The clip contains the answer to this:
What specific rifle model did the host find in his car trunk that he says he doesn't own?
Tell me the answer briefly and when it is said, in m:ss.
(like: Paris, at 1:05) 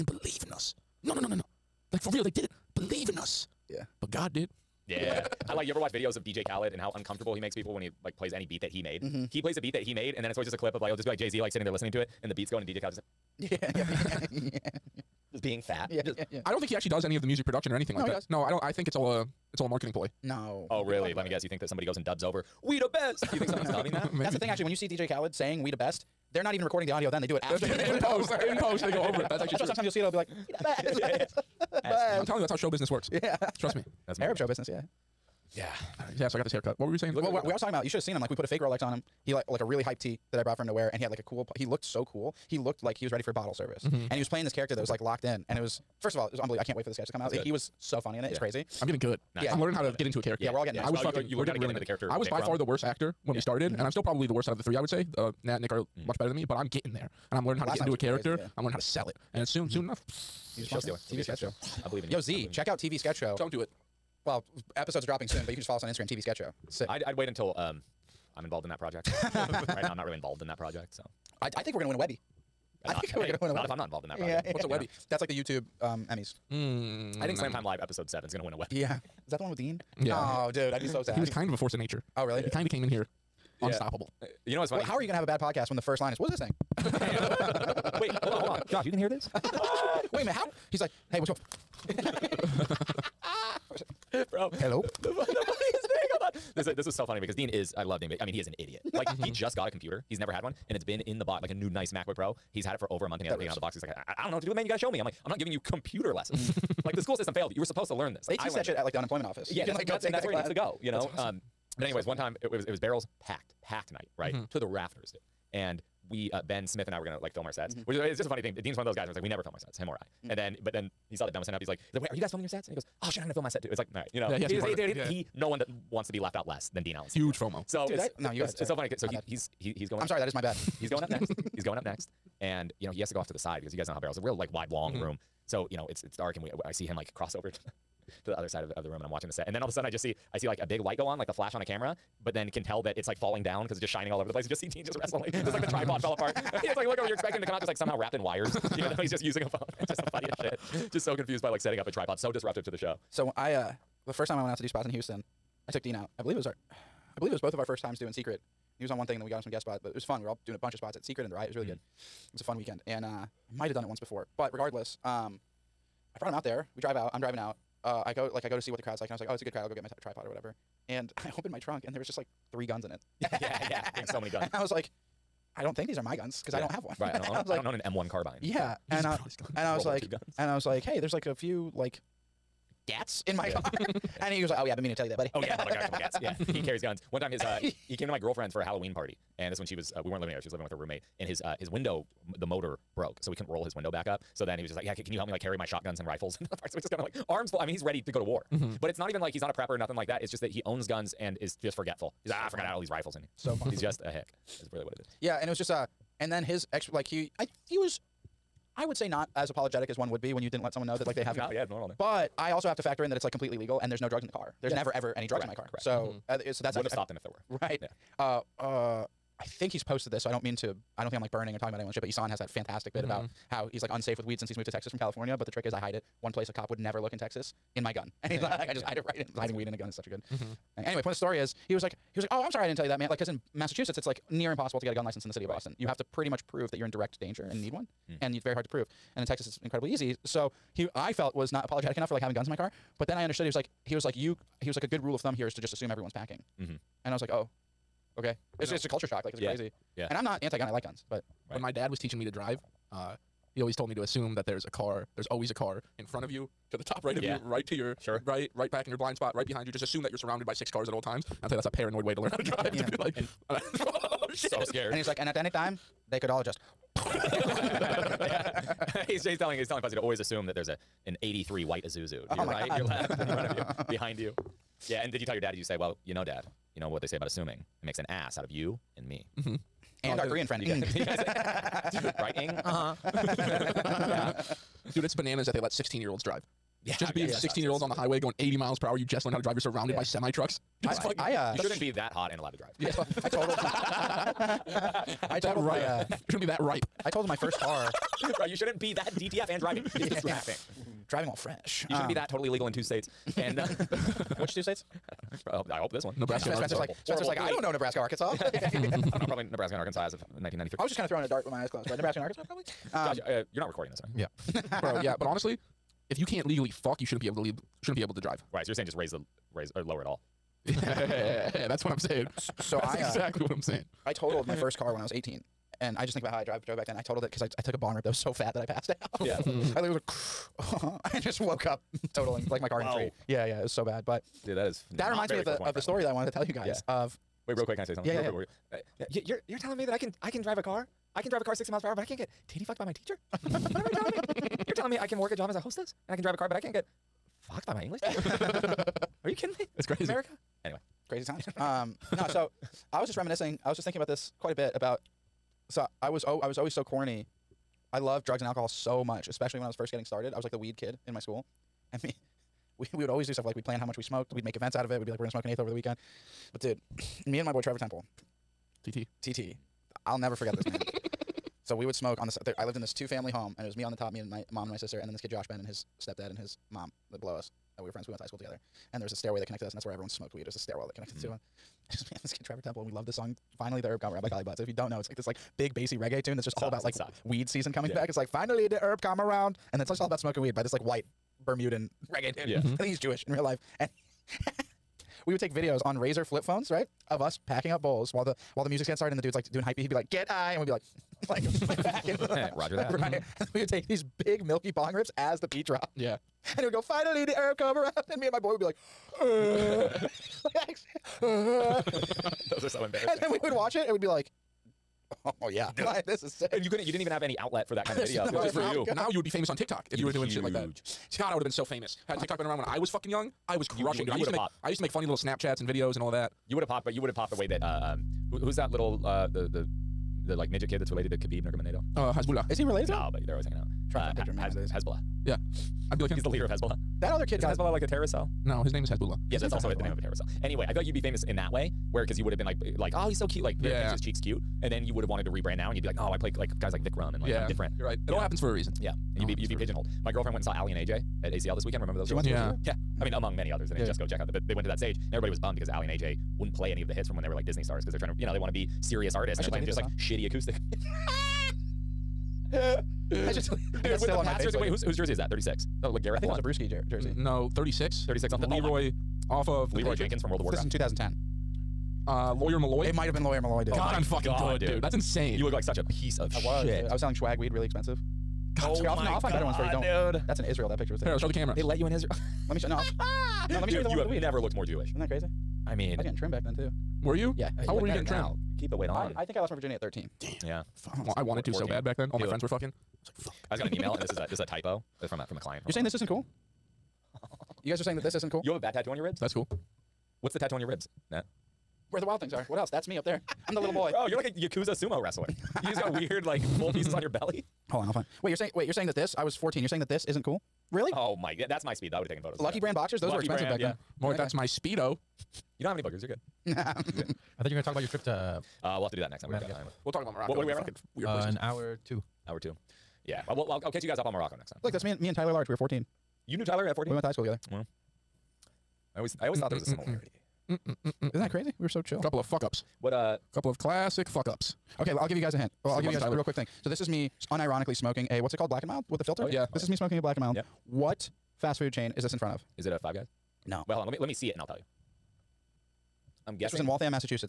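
M1 carbine, at 2:57.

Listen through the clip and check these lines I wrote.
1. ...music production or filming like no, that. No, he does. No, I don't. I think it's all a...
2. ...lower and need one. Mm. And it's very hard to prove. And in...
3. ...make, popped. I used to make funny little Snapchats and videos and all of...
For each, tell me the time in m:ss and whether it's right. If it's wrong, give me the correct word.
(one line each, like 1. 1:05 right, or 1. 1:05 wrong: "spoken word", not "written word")
1. 0:17 wrong: "anything", not "filming"
2. 3:57 wrong: "danger", not "lower"
3. 7:04 right.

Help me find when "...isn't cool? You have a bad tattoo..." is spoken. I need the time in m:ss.
8:18.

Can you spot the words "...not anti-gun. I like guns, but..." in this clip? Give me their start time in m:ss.
4:10.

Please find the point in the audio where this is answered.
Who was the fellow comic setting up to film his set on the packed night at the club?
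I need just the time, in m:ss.
1:56.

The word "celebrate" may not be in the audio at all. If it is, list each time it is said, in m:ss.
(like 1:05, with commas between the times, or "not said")
not said.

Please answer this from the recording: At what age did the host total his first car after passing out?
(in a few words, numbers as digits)
18.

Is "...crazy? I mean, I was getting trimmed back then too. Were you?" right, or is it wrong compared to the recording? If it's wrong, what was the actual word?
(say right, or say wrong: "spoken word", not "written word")
right.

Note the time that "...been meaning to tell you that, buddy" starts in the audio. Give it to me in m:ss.
3:04.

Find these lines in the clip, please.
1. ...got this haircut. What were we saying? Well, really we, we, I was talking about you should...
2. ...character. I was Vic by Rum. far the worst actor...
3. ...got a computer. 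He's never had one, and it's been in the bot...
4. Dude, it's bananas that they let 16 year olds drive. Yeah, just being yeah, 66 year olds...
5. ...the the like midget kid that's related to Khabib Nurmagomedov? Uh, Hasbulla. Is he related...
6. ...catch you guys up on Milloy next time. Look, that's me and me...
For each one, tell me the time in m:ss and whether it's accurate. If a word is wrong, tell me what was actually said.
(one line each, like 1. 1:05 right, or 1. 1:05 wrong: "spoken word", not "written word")
1. 0:36 right
2. 0:51 right
3. 1:39 right
4. 4:44 wrong: "16", not "66"
5. 7:09 right
6. 8:43 wrong: "Morocco", not "Milloy".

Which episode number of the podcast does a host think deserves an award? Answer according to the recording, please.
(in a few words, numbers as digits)
7.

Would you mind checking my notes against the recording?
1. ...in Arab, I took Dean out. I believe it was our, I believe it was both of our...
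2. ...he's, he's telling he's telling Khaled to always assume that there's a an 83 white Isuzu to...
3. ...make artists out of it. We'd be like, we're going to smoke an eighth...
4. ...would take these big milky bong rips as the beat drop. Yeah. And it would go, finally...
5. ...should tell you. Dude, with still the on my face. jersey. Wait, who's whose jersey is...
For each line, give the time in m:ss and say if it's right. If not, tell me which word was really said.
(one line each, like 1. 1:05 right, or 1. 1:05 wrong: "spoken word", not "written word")
1. 2:34 wrong: "Houston", not "Arab"
2. 4:29 wrong: "Fuzzy", not "Khaled"
3. 6:04 wrong: "events", not "artists"
4. 6:43 right
5. 7:43 right.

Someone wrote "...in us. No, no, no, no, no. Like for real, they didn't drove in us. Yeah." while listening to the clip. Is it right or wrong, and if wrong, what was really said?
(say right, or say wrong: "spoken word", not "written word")
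wrong: "believe", not "drove".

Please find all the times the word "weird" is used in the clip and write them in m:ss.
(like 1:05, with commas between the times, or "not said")
8:25, 8:40.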